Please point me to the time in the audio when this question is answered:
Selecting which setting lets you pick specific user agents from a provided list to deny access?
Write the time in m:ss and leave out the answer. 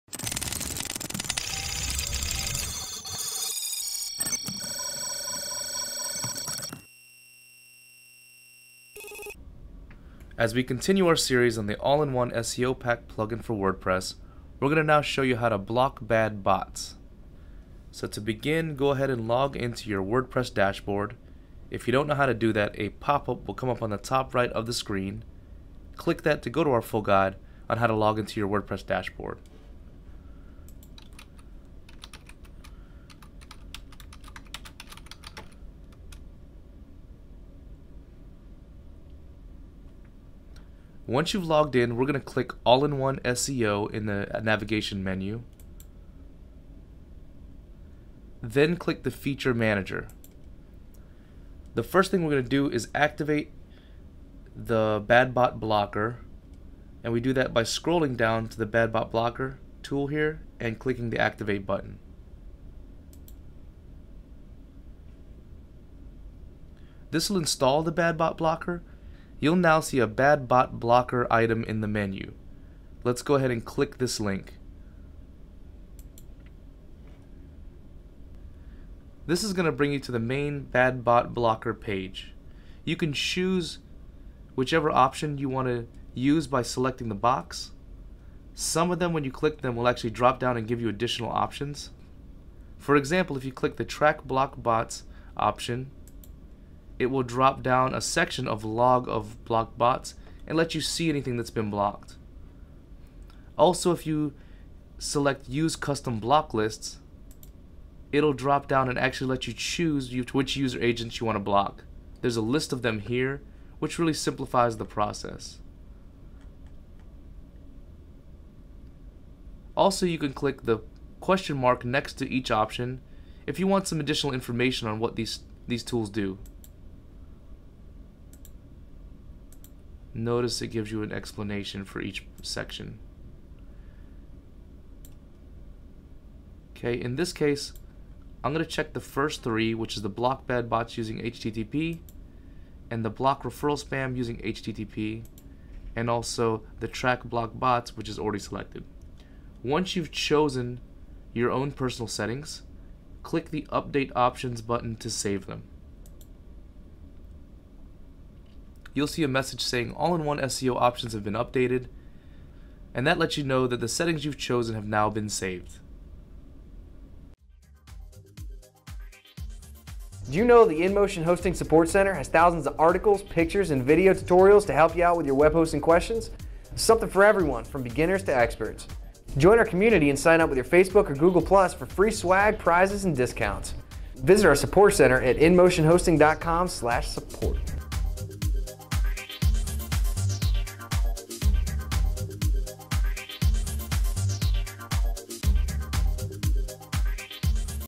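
1:45.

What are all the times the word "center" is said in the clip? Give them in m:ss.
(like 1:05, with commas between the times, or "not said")
2:51, 3:04.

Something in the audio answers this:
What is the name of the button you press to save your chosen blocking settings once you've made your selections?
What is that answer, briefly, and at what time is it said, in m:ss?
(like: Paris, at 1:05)
Update Options, at 2:33.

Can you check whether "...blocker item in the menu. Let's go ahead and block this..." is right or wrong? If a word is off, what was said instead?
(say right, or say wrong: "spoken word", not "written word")
wrong: "click", not "block".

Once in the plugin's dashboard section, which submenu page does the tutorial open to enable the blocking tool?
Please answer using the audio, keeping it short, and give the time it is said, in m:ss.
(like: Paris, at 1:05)
Feature Manager, at 0:49.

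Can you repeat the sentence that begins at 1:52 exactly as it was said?
There's a list of them here, which really simplifies the process.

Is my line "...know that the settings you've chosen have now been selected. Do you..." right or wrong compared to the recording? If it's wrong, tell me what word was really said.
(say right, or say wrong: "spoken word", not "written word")
wrong: "saved", not "selected".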